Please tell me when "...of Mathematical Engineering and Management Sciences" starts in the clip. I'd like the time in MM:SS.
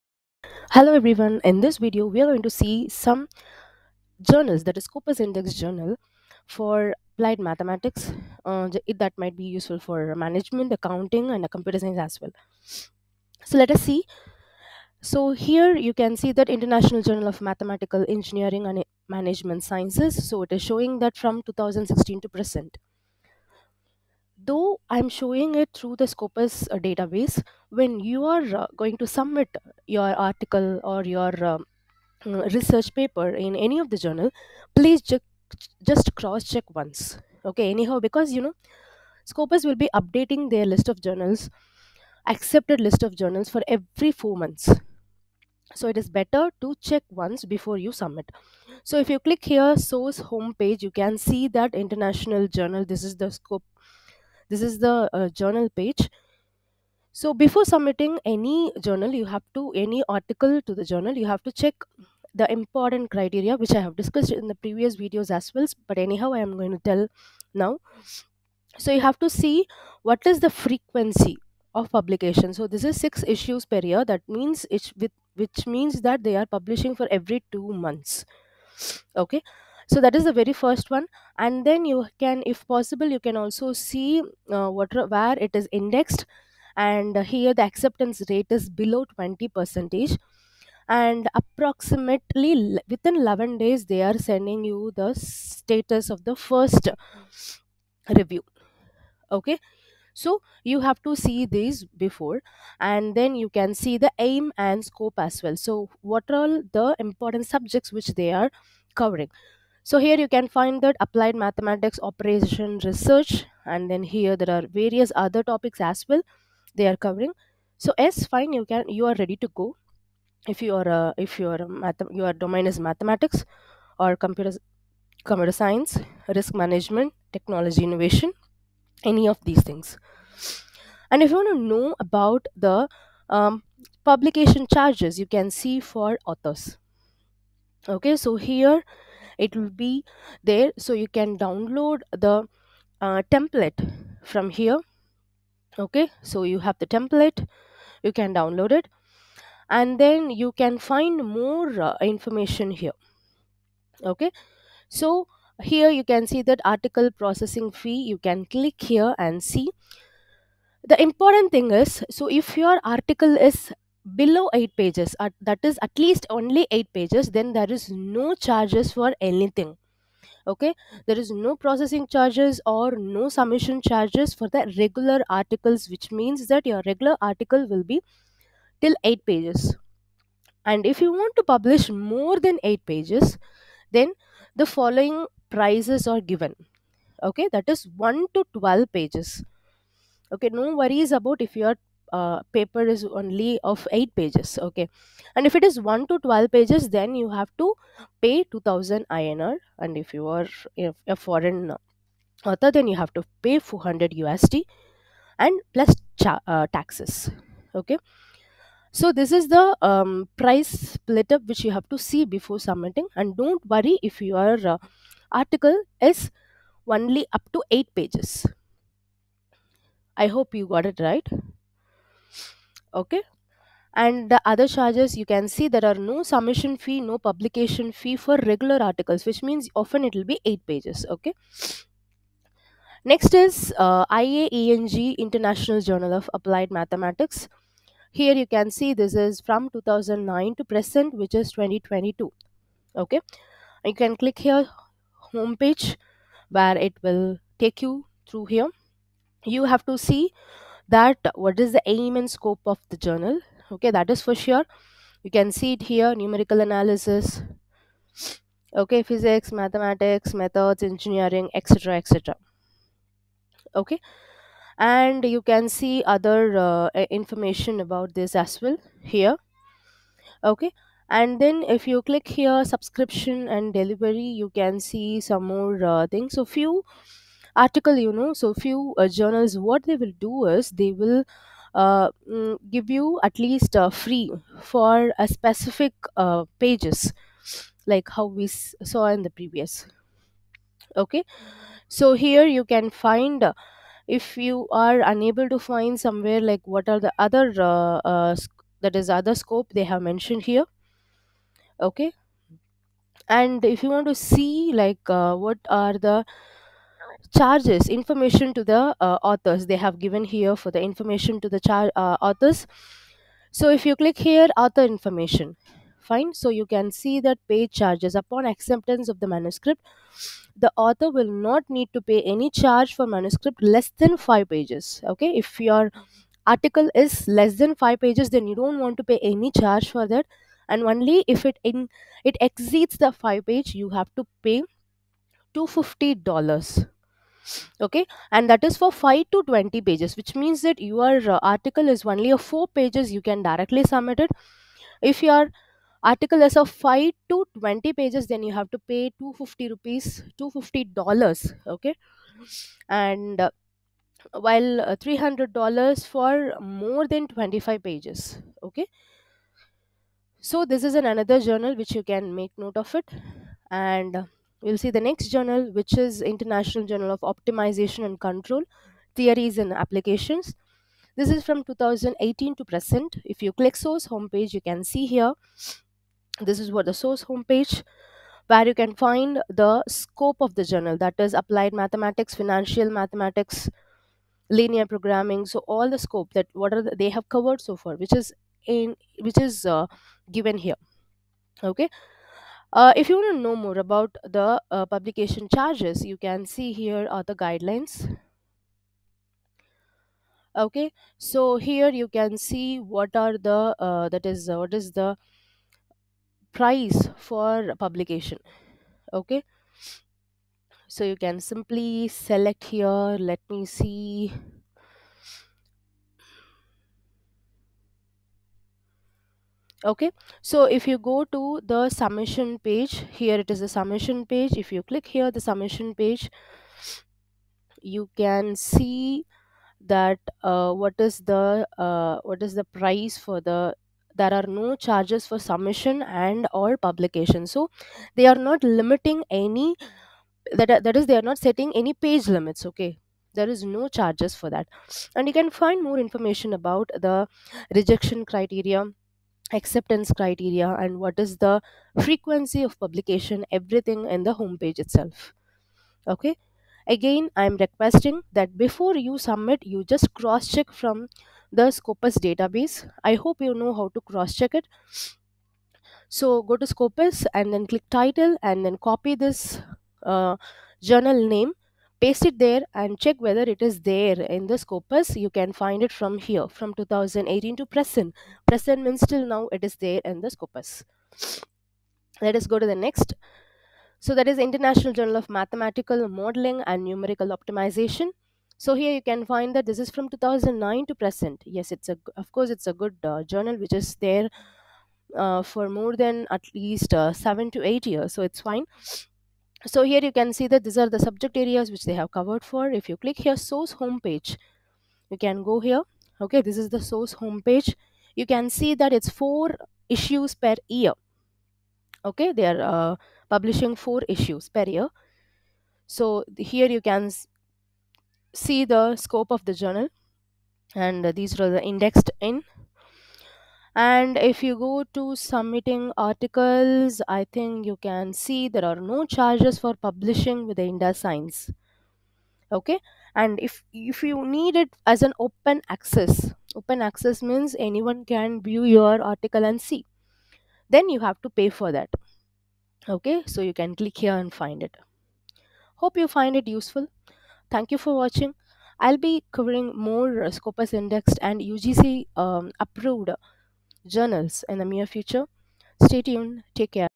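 00:17.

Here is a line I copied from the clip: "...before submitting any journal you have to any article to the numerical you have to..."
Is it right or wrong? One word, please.
wrong.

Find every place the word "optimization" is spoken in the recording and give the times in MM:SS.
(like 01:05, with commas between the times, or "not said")
06:07, 08:07.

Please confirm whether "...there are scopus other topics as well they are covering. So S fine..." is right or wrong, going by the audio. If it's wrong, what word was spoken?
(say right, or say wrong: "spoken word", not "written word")
wrong: "various", not "scopus".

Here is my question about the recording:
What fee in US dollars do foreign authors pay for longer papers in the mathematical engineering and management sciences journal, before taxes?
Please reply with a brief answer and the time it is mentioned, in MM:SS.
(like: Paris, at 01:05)
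400 USD, at 03:23.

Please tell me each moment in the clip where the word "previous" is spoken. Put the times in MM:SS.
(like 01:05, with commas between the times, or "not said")
01:04, 04:49.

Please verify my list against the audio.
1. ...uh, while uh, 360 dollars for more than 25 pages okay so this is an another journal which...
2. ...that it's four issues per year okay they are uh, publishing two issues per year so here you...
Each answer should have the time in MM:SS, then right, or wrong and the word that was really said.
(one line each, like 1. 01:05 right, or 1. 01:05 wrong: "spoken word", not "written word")
1. 05:53 wrong: "300", not "360"
2. 08:28 wrong: "four", not "two".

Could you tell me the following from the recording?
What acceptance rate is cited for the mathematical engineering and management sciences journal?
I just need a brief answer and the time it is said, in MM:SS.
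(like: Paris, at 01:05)
below 20 percent, at 01:28.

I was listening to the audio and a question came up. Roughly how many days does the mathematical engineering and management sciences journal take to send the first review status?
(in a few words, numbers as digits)
11 days.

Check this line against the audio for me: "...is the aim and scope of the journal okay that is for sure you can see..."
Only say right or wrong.
right.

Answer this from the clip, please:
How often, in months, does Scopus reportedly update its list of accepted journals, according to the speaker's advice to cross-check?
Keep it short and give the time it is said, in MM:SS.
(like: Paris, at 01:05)
4 months, at 00:44.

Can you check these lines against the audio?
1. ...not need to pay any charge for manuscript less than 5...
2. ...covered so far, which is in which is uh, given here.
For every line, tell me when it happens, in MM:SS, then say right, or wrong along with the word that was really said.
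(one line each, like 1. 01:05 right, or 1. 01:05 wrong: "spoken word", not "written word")
1. 05:21 right
2. 06:27 right.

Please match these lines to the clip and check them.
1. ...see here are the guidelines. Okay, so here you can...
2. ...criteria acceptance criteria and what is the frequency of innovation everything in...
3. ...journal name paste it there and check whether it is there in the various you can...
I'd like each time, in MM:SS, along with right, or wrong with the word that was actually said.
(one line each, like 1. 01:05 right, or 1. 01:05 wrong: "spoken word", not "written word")
1. 06:36 right
2. 07:28 wrong: "publication", not "innovation"
3. 07:50 wrong: "scopus", not "various".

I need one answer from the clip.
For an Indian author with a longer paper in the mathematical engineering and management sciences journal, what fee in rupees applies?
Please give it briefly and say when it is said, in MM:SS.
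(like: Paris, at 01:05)
2000 INR, at 03:18.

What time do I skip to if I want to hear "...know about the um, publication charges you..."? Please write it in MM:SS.
02:11.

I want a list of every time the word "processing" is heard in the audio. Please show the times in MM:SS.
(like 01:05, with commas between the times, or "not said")
02:37, 02:51.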